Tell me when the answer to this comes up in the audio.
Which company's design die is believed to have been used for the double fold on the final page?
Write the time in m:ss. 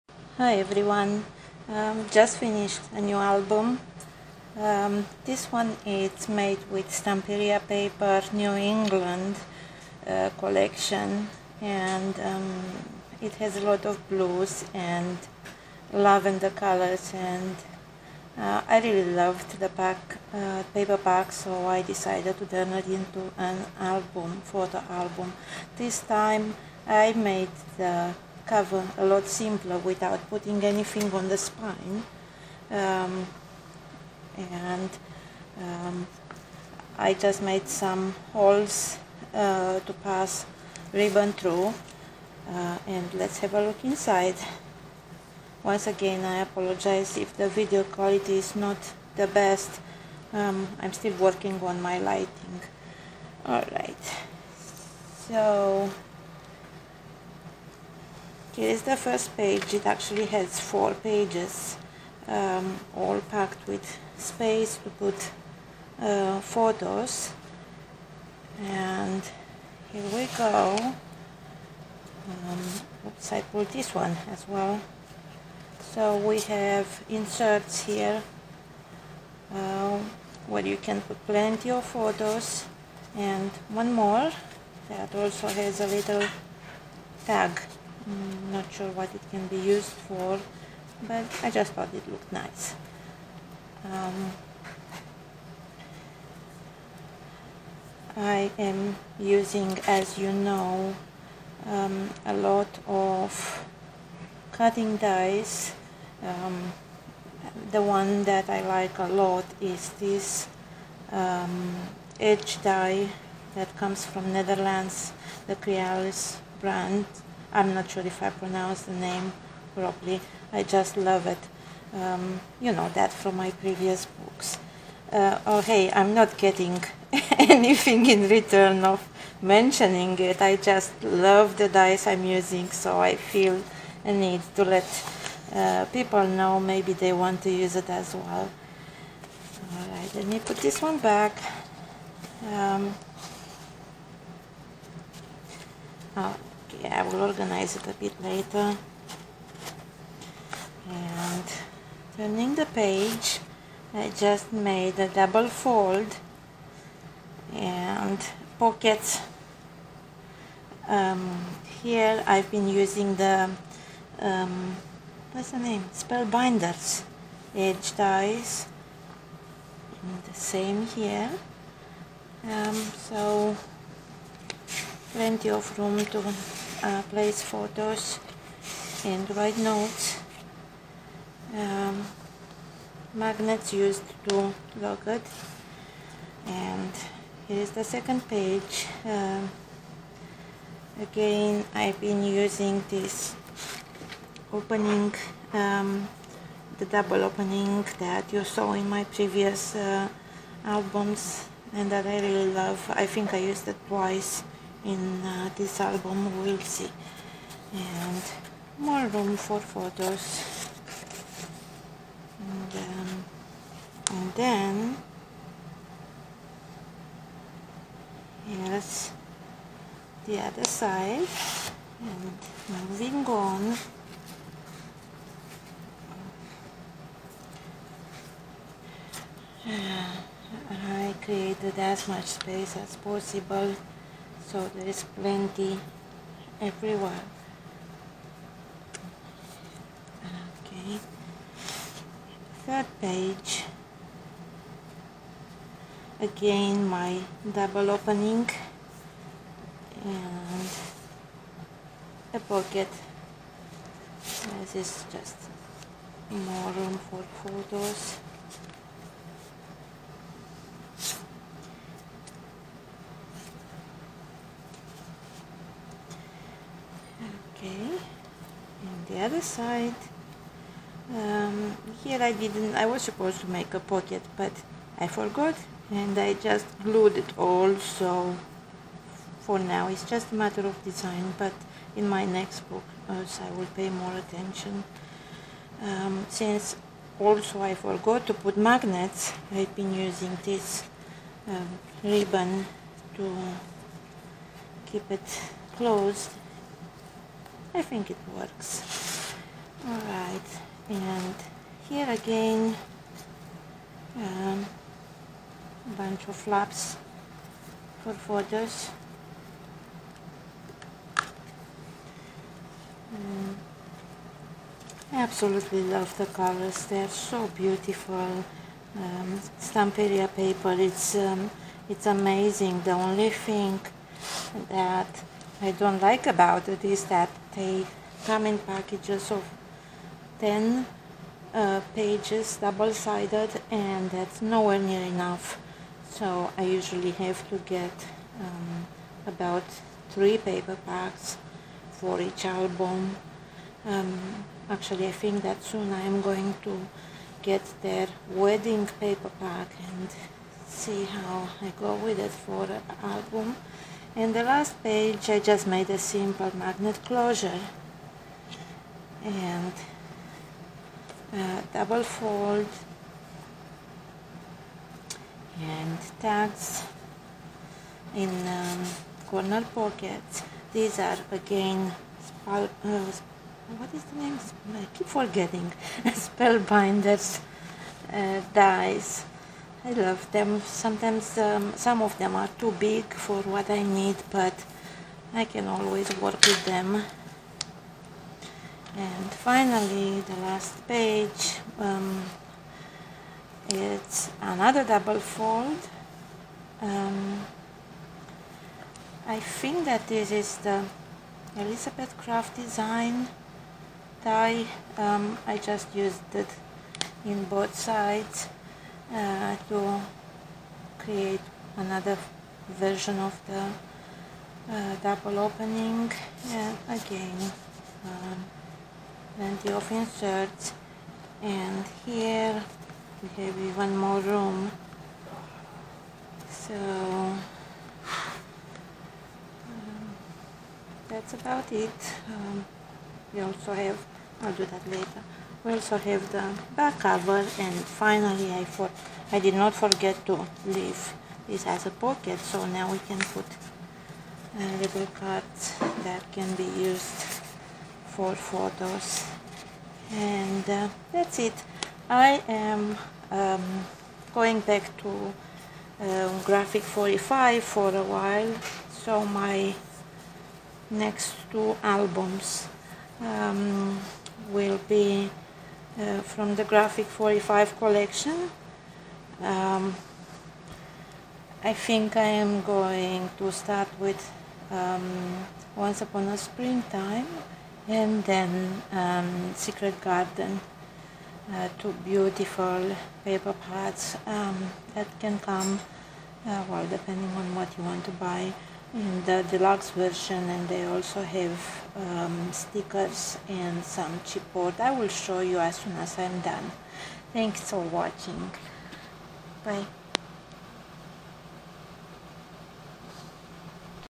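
6:41.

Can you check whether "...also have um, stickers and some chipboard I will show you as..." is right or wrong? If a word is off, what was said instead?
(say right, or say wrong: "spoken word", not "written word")
right.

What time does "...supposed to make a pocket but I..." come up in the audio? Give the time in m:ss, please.
4:33.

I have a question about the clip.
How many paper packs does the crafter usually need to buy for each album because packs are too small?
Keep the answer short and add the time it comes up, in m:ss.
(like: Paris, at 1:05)
3, at 5:40.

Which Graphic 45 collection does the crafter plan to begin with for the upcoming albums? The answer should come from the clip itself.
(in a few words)
Once Upon a Springtime.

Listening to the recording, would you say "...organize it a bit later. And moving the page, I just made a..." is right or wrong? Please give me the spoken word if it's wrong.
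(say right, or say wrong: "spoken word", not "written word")
wrong: "turning", not "moving".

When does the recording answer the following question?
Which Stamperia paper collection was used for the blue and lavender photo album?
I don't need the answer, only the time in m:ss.
0:08.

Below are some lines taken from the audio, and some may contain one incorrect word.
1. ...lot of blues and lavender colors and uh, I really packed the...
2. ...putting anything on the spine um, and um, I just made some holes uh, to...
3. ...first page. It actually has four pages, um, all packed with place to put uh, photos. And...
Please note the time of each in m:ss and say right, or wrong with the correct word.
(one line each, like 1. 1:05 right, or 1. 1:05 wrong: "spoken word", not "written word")
1. 0:13 wrong: "loved", not "packed"
2. 0:30 right
3. 0:58 wrong: "space", not "place".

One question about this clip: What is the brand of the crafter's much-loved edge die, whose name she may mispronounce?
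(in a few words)
Crealies.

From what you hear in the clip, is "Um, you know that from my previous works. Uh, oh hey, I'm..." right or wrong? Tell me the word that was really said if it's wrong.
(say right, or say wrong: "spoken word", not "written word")
wrong: "books", not "works".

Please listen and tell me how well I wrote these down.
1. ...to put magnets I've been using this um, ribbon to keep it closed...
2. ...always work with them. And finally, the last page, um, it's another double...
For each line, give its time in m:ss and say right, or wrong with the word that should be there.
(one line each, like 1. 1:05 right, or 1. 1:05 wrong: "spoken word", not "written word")
1. 4:48 right
2. 6:25 right.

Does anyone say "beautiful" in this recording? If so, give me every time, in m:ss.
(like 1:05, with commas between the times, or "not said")
5:17, 8:02.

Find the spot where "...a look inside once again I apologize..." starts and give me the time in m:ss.
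0:43.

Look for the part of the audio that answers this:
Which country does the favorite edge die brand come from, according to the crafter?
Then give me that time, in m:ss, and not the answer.
1:54.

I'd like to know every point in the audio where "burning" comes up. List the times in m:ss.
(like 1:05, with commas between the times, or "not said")
not said.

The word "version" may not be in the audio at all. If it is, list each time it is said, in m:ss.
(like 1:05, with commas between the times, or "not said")
6:52, 8:09.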